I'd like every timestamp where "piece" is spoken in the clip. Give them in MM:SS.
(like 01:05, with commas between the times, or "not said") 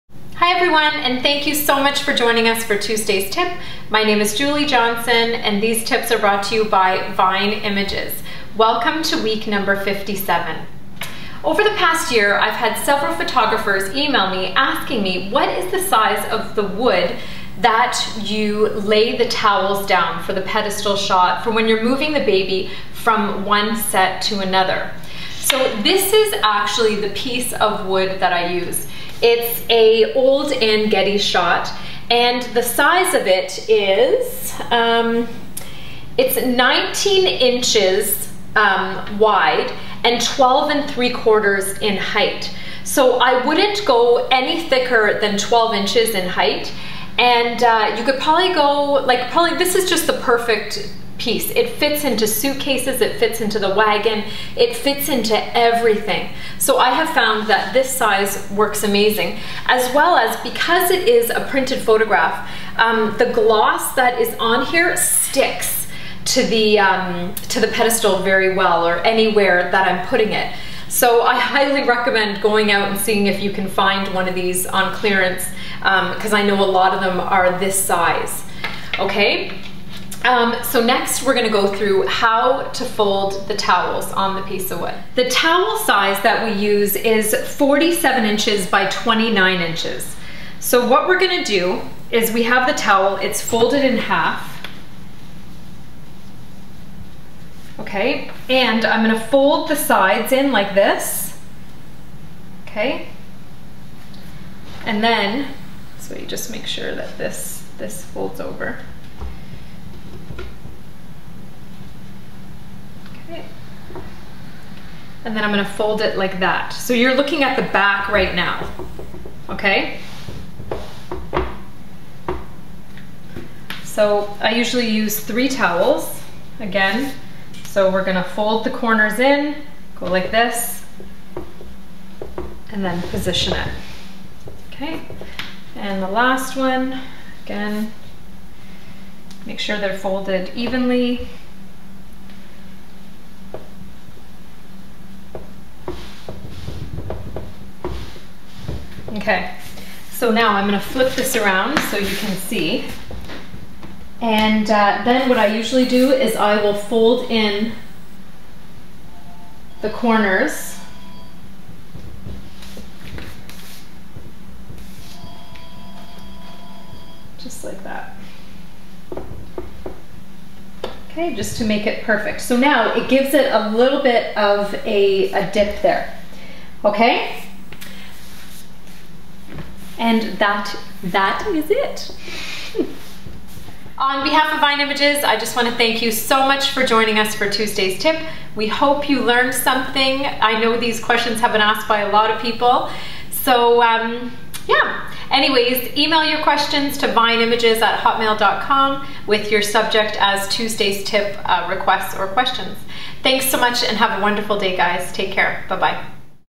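00:27, 00:51, 01:24.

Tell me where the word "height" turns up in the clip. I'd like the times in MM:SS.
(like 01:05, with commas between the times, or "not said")
00:41, 00:46.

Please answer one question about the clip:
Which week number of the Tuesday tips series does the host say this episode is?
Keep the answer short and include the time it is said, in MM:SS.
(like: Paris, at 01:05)
57, at 00:09.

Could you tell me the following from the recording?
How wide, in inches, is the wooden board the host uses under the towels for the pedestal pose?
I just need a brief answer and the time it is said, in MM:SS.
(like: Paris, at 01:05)
19 inches, at 00:36.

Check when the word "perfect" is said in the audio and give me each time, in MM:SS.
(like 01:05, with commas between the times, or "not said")
00:50, 02:52.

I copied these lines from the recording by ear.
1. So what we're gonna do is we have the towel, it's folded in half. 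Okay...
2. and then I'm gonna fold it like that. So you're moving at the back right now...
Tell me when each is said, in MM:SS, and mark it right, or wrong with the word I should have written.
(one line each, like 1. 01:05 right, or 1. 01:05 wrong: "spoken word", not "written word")
1. 01:30 right
2. 01:55 wrong: "looking", not "moving".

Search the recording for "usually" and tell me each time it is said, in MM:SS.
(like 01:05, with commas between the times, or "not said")
02:04, 02:35.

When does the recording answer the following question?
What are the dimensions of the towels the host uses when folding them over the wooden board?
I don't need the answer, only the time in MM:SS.
01:27.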